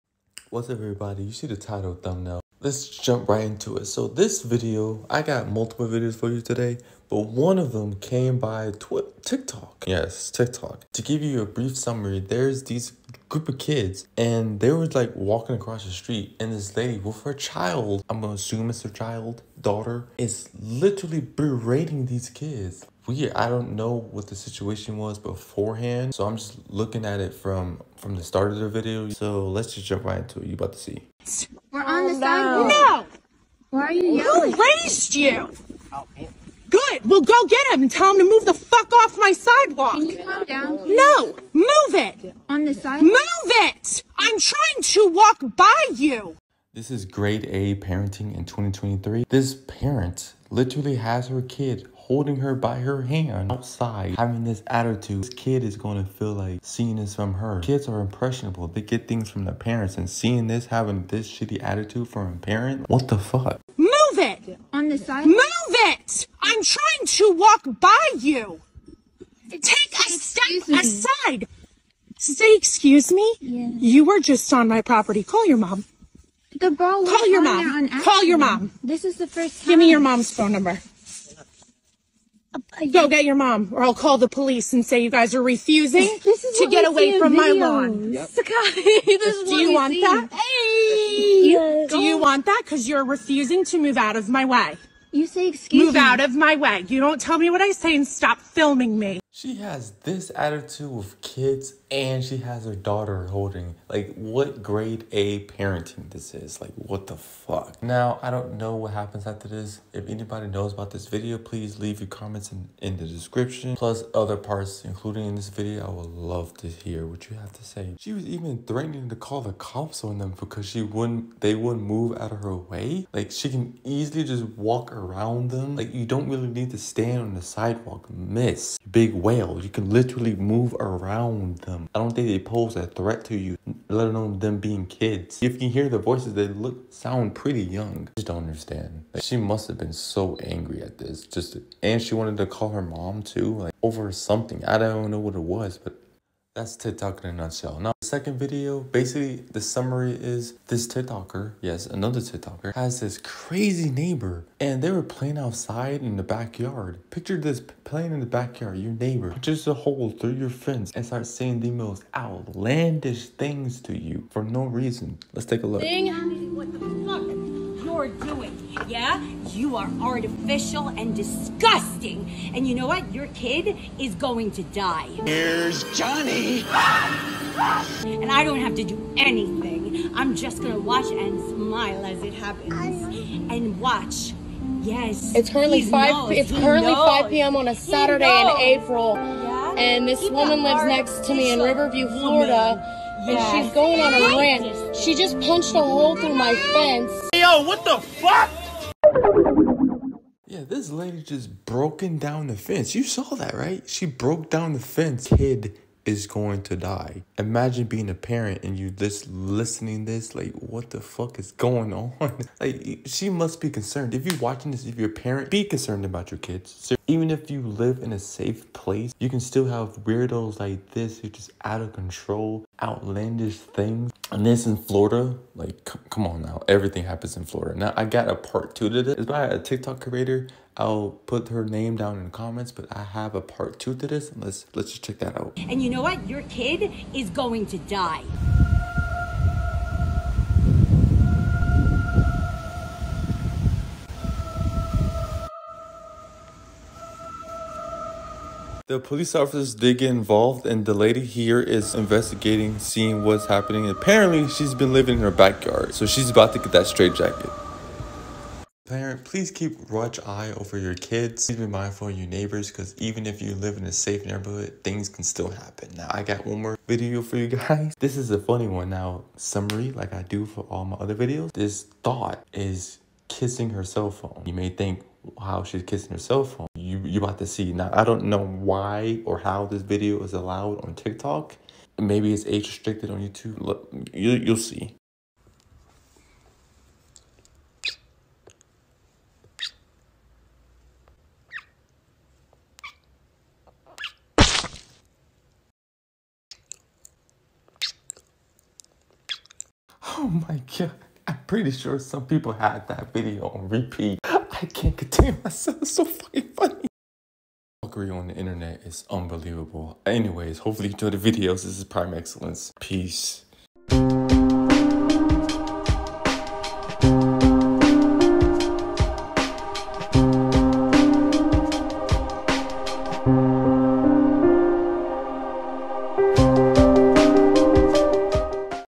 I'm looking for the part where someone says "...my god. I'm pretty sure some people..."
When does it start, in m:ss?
5:00.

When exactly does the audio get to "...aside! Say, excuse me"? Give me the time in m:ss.
1:10.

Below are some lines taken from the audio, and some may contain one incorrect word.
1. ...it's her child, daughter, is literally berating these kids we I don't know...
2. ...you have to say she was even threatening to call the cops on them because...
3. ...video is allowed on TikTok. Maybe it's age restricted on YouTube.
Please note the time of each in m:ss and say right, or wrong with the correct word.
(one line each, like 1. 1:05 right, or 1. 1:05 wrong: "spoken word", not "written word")
1. 0:18 right
2. 1:57 right
3. 4:39 right.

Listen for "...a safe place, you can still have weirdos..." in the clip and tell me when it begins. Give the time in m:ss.
3:38.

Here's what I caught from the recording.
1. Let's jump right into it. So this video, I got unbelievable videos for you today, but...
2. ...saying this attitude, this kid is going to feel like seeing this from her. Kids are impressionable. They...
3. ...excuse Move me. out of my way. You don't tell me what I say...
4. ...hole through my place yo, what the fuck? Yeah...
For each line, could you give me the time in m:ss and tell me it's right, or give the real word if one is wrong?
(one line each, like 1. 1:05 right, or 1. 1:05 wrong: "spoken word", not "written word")
1. 0:02 wrong: "multiple", not "unbelievable"
2. 0:54 wrong: "having", not "saying"
3. 1:35 right
4. 3:15 wrong: "fence", not "place".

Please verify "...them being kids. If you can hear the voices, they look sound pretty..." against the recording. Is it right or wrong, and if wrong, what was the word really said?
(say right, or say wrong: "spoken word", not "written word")
right.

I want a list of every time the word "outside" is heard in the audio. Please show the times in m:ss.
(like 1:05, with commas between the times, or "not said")
0:53, 2:35.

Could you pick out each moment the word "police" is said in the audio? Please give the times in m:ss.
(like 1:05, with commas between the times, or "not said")
1:24, 4:08.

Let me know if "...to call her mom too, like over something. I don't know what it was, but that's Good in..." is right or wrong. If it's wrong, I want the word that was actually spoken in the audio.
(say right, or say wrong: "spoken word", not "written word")
wrong: "TikTok", not "Good".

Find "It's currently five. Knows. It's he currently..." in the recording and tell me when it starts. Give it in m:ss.
3:05.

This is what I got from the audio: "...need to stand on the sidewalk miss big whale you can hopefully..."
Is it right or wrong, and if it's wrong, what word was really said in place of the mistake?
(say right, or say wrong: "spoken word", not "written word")
wrong: "literally", not "hopefully".